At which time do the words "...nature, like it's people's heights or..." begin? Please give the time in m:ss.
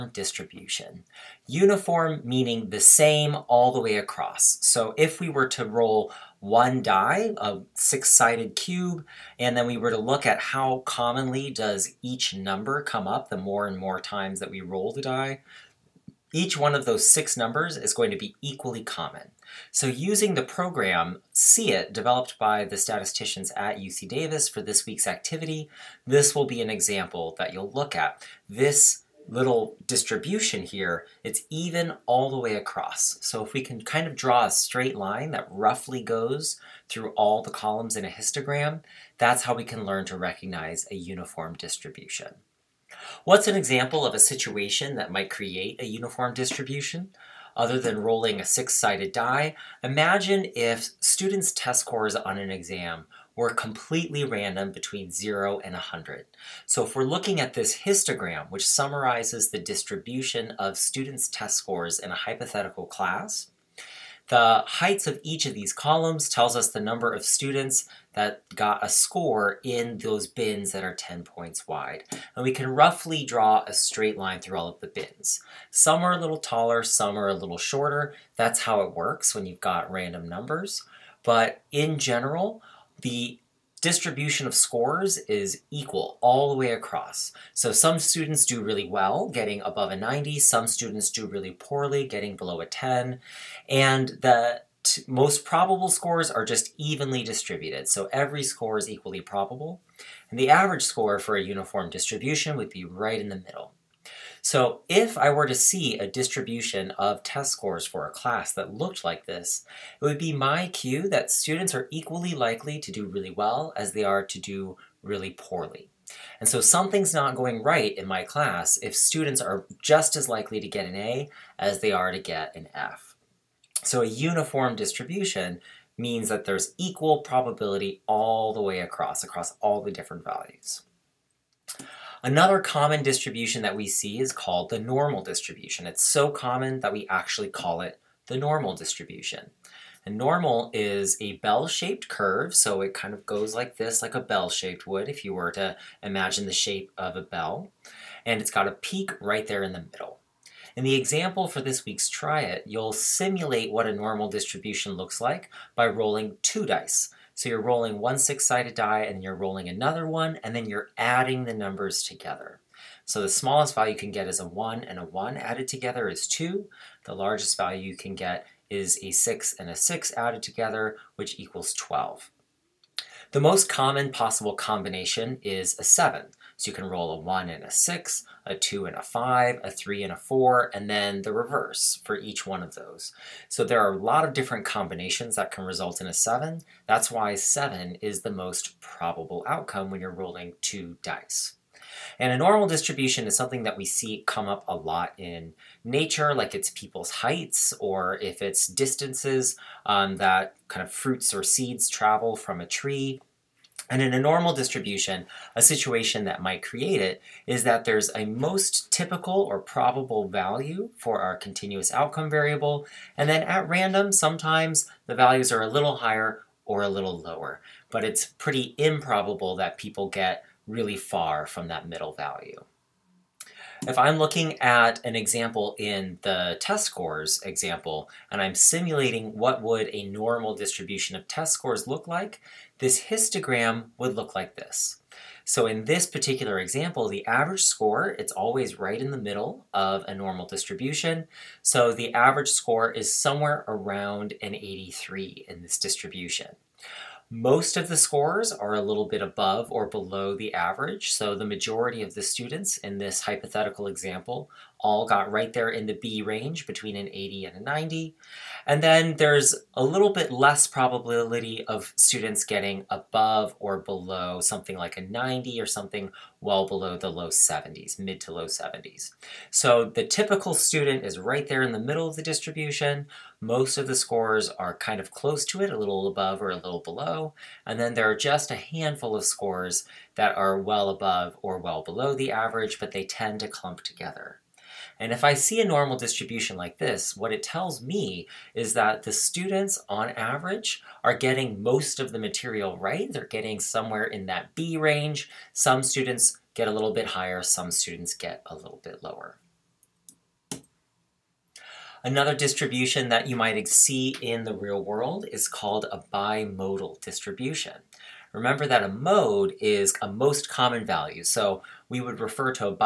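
3:15.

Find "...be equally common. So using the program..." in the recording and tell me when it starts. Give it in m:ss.
0:18.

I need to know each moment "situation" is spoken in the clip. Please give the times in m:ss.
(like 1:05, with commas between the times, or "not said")
0:44, 3:25.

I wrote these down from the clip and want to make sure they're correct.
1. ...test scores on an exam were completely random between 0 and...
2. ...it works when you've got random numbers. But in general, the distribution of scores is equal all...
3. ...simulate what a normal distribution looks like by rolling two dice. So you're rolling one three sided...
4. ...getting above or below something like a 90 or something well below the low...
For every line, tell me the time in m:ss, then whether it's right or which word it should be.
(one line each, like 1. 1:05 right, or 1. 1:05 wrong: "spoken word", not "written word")
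1. 0:51 right
2. 1:18 right
3. 2:32 wrong: "six", not "three"
4. 4:22 right.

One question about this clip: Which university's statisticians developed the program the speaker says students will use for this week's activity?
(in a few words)
UC Davis.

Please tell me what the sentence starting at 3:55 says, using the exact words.
So in this particular example, the average score, it's always right in the middle of a normal distribution.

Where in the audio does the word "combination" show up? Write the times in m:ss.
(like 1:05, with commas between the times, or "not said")
2:54, 3:04.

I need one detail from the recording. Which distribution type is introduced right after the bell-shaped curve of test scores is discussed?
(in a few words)
bimodal distribution.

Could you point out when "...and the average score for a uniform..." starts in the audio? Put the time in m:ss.
1:40.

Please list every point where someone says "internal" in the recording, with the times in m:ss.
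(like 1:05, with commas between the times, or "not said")
not said.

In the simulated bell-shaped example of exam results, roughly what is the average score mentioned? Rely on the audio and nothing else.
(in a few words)
83.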